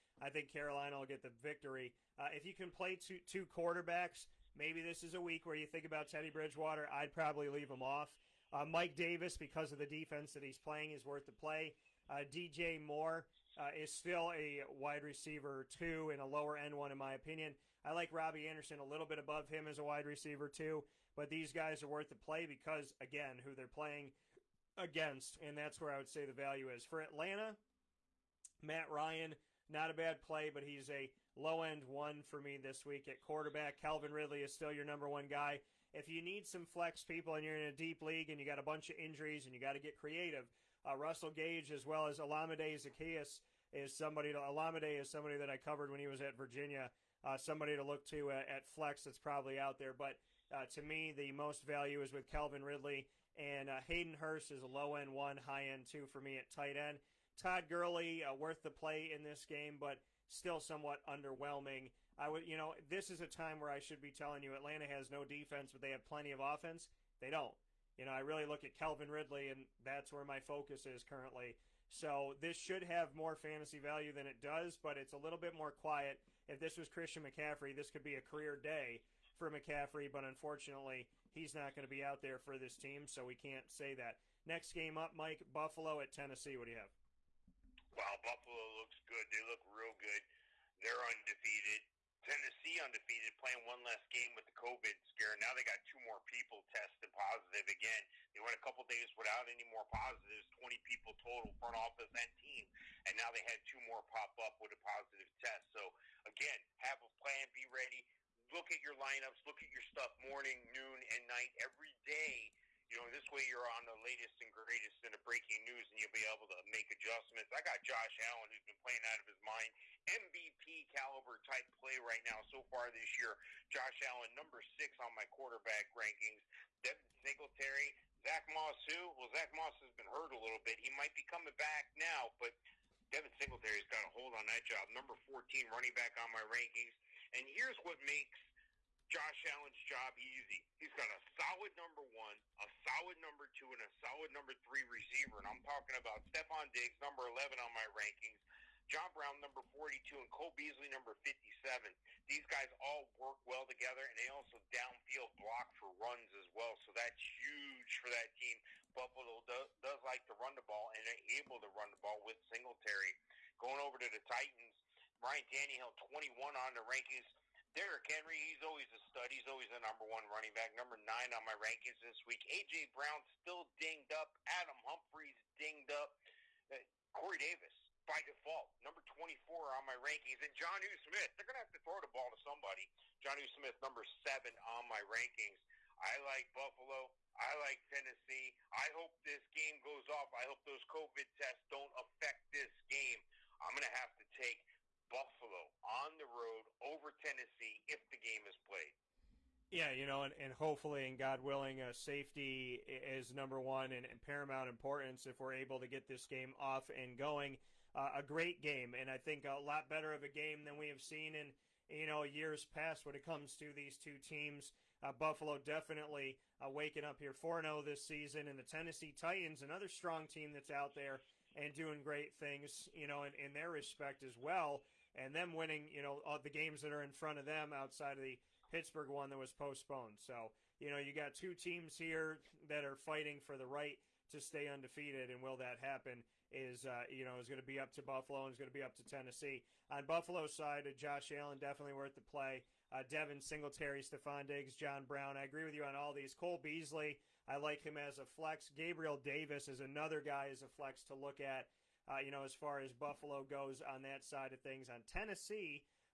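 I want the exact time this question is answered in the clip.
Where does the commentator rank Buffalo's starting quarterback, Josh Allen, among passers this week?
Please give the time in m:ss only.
2:04.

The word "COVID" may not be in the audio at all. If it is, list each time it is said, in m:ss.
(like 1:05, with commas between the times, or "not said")
1:34, 3:10.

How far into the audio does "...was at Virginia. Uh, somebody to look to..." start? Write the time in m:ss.
0:46.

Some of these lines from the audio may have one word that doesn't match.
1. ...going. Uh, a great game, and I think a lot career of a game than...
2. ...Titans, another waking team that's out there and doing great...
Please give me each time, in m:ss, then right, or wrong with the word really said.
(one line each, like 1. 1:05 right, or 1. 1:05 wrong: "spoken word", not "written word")
1. 3:27 wrong: "better", not "career"
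2. 3:39 wrong: "strong", not "waking".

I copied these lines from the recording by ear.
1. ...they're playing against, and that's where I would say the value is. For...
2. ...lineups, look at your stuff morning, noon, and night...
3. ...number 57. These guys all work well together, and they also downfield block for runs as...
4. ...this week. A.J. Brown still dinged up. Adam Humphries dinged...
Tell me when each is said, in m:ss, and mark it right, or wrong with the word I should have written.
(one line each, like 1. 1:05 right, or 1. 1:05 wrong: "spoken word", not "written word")
1. 0:23 right
2. 1:48 right
3. 2:30 right
4. 2:52 right.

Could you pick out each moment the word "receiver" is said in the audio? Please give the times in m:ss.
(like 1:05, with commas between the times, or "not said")
0:15, 0:20, 2:24.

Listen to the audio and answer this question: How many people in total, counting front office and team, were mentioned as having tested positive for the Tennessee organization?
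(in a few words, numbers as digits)
20.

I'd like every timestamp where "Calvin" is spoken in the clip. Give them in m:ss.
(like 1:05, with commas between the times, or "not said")
0:33, 0:52, 1:08.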